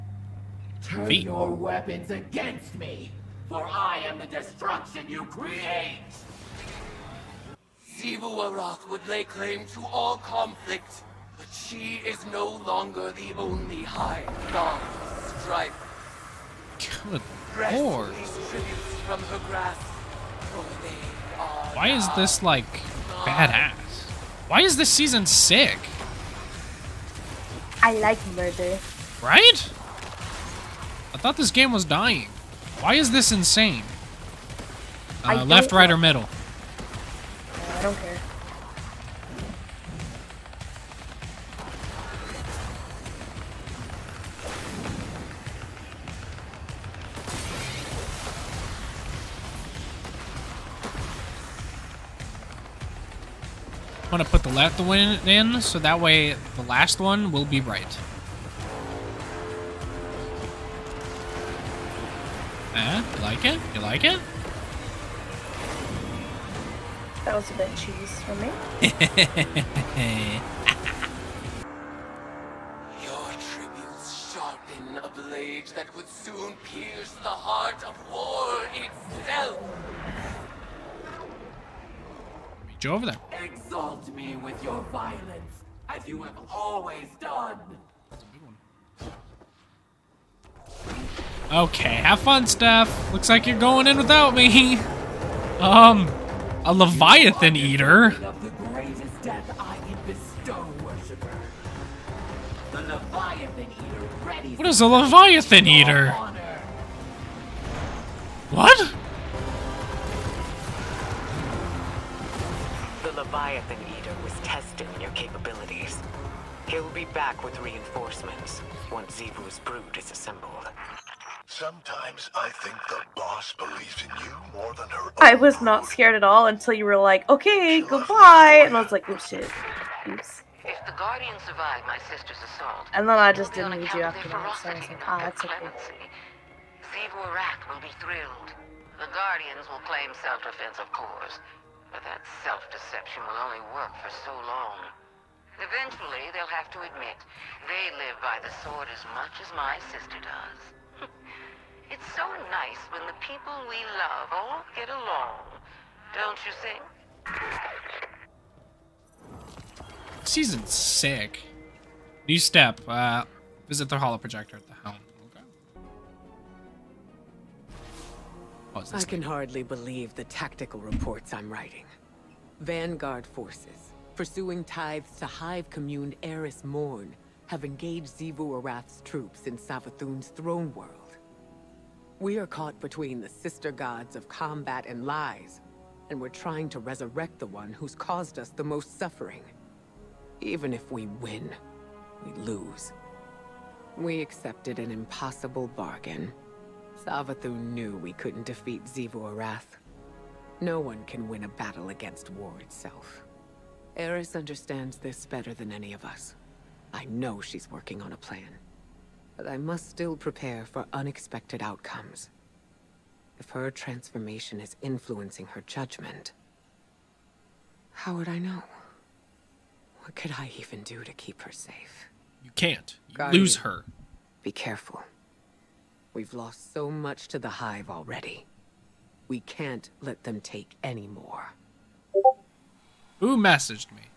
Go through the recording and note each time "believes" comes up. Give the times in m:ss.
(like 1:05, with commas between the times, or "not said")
2:03, 2:49.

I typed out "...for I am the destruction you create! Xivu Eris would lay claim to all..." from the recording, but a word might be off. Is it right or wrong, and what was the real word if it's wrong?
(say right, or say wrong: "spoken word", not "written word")
wrong: "Arath", not "Eris".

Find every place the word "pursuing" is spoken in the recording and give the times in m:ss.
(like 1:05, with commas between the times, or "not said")
2:54.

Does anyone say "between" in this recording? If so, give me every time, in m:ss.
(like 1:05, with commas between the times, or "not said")
3:02.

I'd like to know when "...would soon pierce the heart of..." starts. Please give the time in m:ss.
1:15.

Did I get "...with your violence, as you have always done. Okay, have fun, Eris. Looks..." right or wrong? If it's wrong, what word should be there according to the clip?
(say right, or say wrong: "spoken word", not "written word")
wrong: "Steph", not "Eris".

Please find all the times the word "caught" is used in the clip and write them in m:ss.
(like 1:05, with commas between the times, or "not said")
3:02.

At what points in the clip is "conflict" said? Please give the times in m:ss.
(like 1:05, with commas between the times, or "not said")
0:10.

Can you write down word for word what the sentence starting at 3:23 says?
Eris understands this better than any of us.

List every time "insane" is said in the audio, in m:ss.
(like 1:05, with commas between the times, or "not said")
0:33.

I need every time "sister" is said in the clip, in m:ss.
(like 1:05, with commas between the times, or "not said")
2:12, 2:29, 3:03.